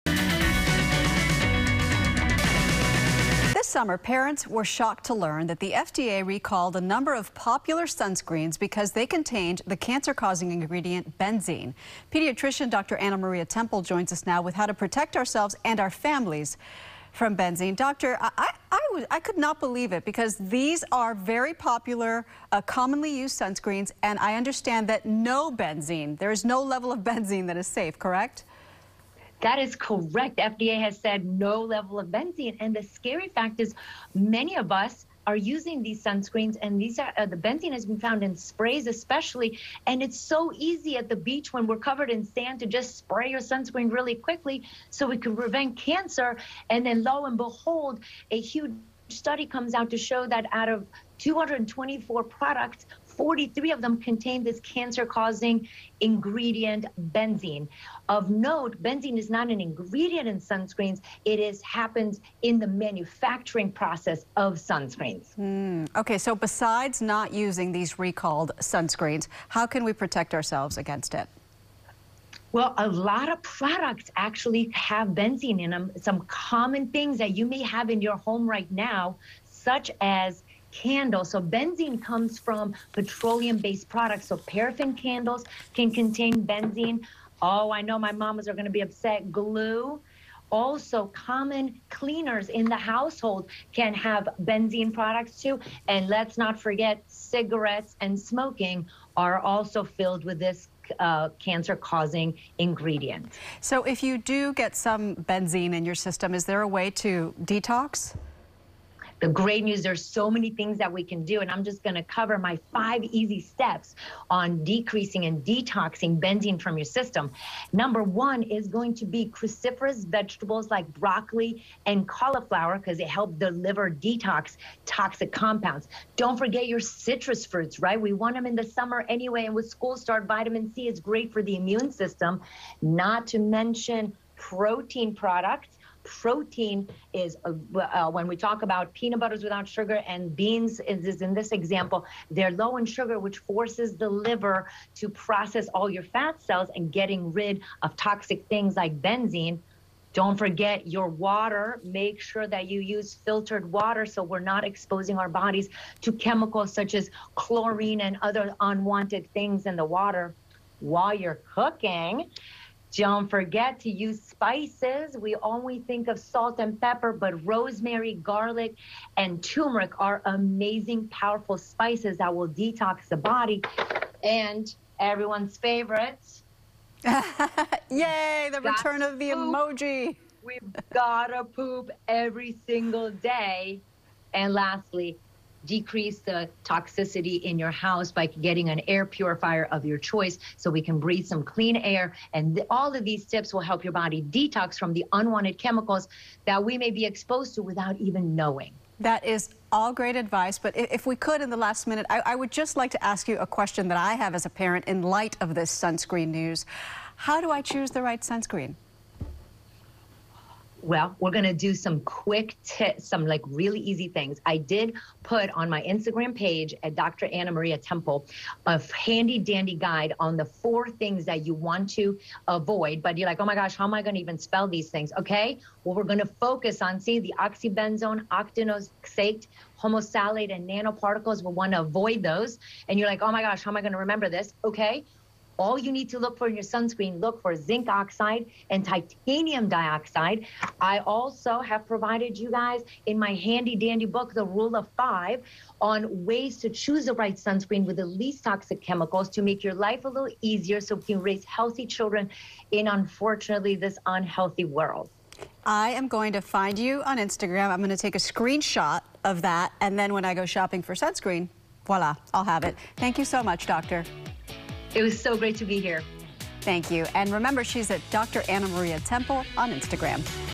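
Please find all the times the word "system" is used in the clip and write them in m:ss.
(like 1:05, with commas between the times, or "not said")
1:45, 1:56, 2:11.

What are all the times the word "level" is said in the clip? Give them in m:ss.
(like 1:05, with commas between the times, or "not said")
0:26, 0:31.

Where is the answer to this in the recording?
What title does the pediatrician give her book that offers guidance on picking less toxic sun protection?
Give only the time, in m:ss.
4:04.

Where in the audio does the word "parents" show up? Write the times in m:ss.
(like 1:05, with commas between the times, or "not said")
0:03, 3:24.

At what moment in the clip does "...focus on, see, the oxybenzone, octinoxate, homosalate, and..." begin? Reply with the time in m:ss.
3:46.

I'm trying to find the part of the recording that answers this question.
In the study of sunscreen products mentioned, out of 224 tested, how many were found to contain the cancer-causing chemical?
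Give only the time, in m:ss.
0:53.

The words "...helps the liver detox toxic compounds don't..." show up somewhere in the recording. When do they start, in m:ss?
2:03.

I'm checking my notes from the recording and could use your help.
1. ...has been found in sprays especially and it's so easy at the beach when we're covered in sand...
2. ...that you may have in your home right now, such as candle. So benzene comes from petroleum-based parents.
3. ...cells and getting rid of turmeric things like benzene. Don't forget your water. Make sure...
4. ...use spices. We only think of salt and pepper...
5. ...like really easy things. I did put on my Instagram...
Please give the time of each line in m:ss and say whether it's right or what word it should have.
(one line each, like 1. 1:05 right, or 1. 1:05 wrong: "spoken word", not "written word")
1. 0:37 right
2. 1:17 wrong: "products", not "parents"
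3. 2:26 wrong: "toxic", not "turmeric"
4. 2:43 right
5. 3:33 right.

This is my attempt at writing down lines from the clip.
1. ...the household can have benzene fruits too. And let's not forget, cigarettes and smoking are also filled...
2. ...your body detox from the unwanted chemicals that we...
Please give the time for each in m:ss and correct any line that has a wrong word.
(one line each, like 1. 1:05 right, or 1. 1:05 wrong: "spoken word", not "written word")
1. 1:32 wrong: "products", not "fruits"
2. 3:13 right.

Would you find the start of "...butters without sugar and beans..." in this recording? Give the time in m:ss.
2:19.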